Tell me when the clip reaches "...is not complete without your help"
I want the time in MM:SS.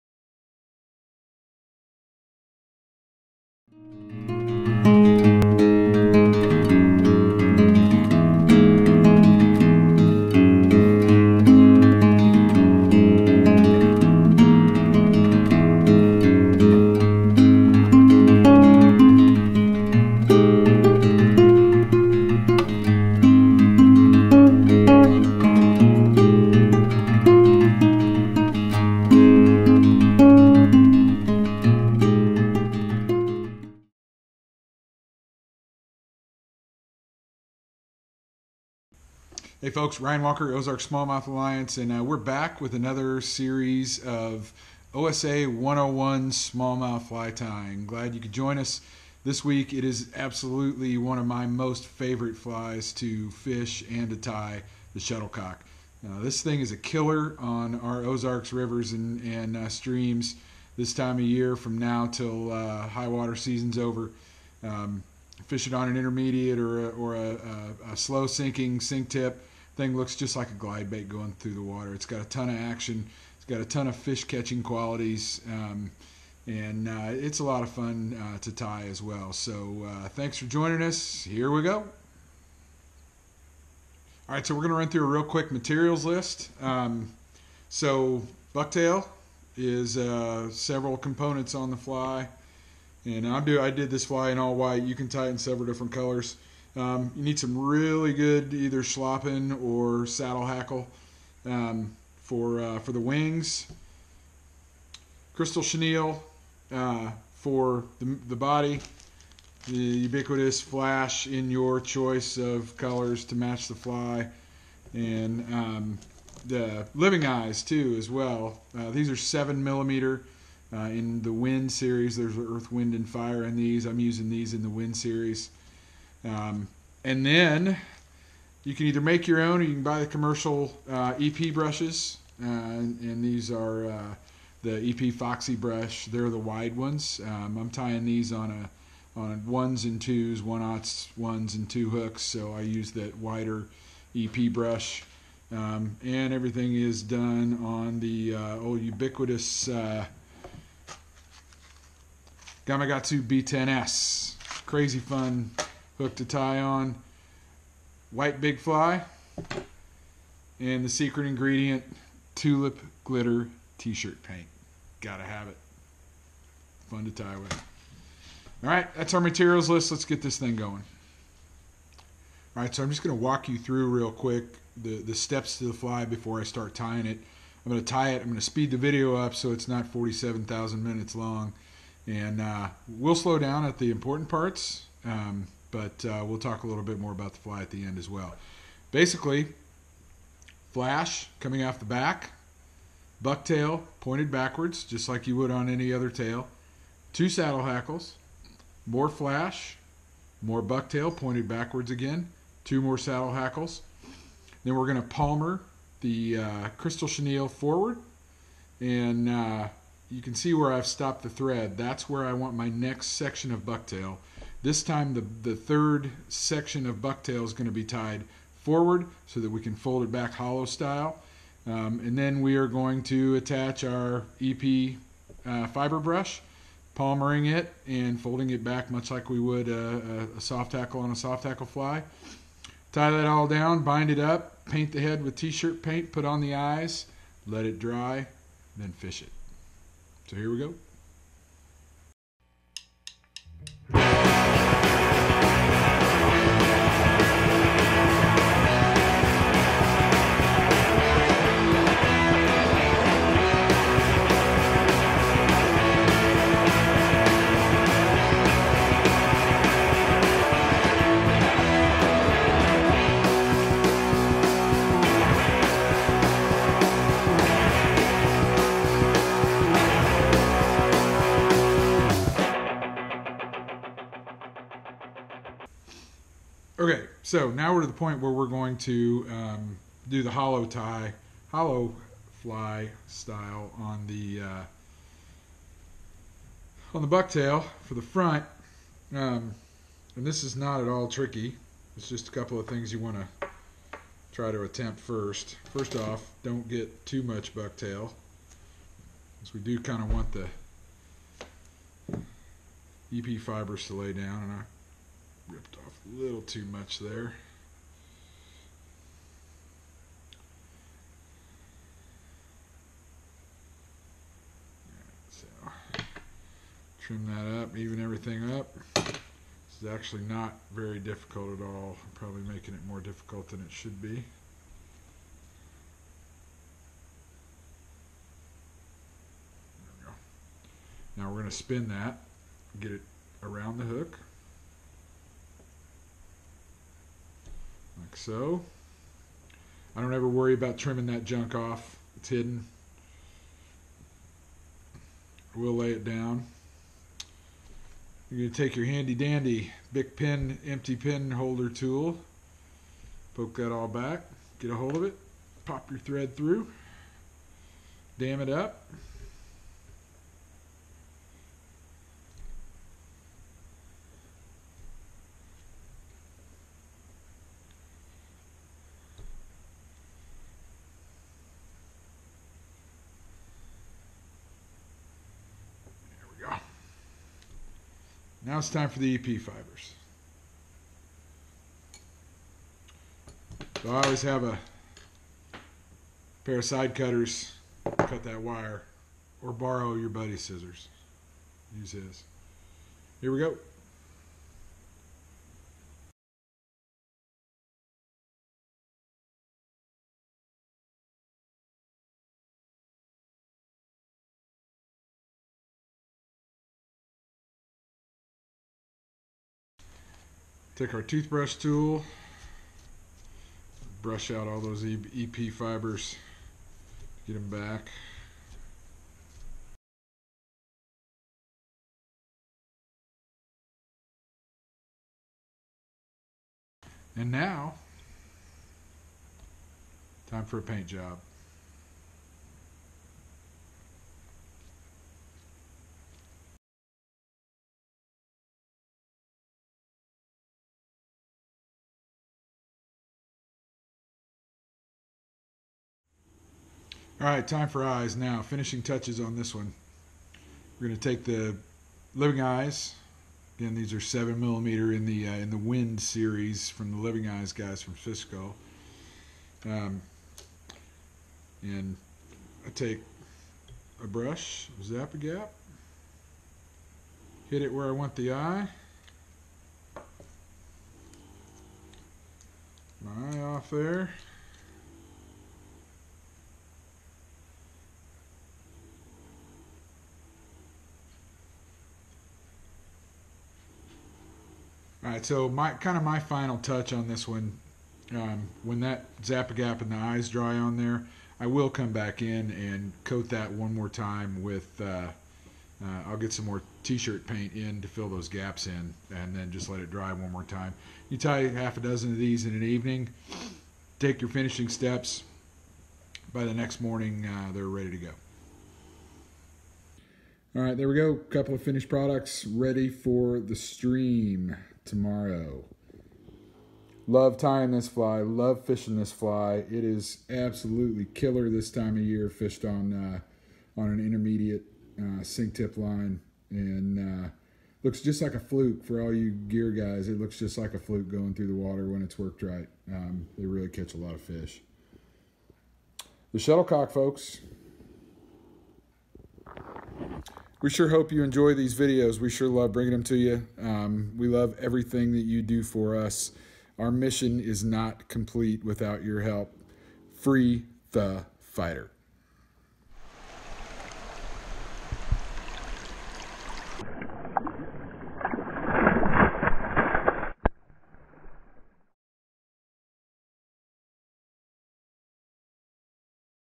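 09:07.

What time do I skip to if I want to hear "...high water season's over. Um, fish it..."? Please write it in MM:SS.
01:02.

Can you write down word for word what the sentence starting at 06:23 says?
So I always have a pair of side cutters, cut that wire, or borrow your buddy's scissors.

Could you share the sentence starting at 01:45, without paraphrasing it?
Crystal chenille uh, for the, the body.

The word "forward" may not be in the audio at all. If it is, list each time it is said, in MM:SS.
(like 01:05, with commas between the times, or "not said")
03:27, 03:38.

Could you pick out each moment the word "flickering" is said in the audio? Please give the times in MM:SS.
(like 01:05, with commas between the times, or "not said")
not said.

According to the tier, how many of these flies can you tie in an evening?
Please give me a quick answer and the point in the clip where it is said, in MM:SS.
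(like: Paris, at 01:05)
6, at 08:21.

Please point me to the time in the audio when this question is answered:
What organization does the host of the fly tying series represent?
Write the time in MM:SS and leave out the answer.
00:40.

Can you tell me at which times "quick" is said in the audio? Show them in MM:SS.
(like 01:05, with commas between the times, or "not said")
01:25, 02:54.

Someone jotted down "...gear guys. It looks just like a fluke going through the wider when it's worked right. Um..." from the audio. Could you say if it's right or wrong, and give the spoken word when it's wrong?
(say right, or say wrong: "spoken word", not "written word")
wrong: "water", not "wider".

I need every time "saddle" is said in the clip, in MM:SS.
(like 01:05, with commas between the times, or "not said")
01:40, 03:17, 03:22.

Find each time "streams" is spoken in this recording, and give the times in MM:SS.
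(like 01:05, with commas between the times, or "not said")
00:59, 08:33.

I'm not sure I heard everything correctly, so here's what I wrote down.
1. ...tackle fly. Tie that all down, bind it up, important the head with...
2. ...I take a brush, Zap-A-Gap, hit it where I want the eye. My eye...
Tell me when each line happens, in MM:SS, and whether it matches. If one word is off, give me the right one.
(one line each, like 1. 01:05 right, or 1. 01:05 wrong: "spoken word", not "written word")
1. 03:51 wrong: "paint", not "important"
2. 07:42 right.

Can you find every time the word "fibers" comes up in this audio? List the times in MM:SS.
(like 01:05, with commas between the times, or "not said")
03:45, 05:03, 06:19, 06:55.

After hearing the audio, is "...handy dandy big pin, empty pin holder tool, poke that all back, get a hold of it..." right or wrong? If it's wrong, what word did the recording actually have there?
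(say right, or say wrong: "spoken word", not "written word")
right.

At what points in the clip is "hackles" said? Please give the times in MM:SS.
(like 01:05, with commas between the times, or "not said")
01:40, 03:17, 03:23.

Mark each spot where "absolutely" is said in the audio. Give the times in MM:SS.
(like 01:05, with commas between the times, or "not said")
00:50, 08:40.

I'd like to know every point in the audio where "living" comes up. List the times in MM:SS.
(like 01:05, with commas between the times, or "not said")
01:56, 07:32, 07:36.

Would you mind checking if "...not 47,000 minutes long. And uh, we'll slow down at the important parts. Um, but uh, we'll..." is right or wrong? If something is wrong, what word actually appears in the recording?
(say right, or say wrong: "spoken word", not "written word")
right.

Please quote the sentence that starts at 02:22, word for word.
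So I use that wider EP brush.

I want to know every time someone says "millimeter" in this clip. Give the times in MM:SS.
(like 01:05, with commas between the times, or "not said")
01:59, 07:34.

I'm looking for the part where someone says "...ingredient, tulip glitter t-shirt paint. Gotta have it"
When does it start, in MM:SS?
02:41.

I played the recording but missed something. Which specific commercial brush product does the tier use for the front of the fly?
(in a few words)
EP Foxy brush.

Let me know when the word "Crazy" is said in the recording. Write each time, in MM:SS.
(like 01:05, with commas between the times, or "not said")
02:34.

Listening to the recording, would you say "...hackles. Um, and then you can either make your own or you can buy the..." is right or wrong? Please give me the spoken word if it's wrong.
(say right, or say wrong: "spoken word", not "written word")
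wrong: "series", not "hackles".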